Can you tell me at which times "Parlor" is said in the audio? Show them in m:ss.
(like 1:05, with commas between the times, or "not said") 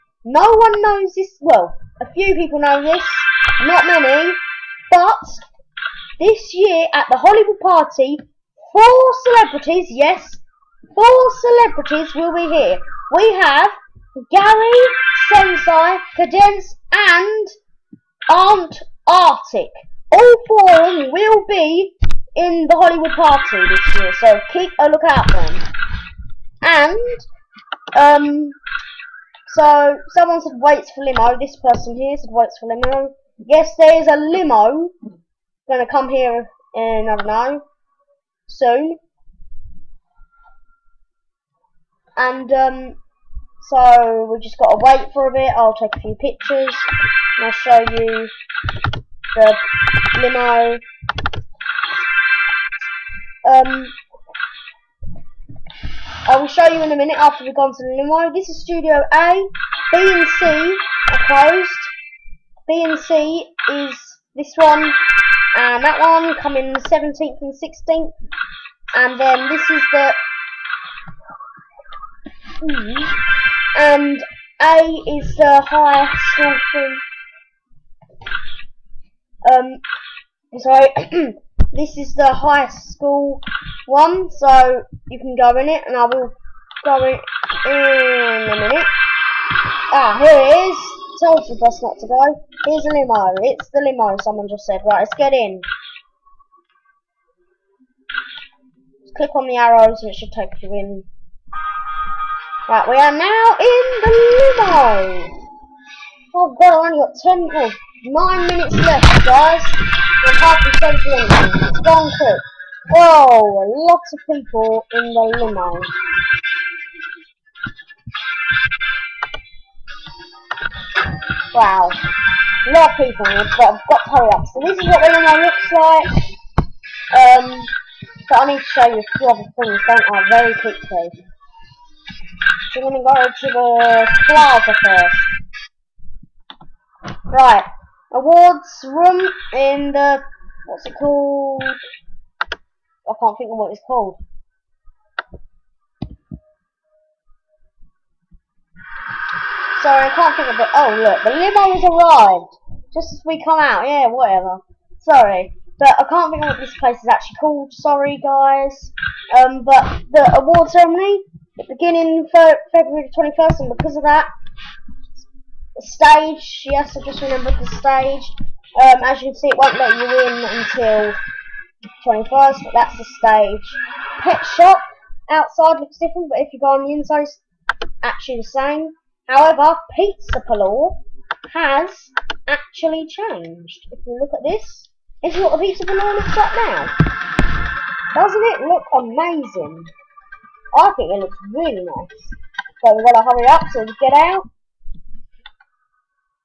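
3:00, 3:05.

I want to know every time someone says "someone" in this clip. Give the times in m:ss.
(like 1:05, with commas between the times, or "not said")
0:30, 1:34.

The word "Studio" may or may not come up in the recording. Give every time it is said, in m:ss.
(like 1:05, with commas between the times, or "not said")
0:58.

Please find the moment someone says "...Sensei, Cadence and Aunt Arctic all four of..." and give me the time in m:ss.
0:15.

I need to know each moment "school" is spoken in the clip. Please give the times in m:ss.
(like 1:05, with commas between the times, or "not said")
1:16, 1:22.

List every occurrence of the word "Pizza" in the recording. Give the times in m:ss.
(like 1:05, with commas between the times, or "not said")
2:59, 3:05.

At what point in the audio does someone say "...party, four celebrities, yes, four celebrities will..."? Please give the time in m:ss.
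0:07.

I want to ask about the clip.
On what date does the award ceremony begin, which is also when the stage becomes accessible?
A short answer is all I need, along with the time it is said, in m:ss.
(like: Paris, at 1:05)
February 21st, at 2:42.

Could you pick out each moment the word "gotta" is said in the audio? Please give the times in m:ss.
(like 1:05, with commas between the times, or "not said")
0:44.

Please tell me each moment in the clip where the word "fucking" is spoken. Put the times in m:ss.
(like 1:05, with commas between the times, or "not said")
not said.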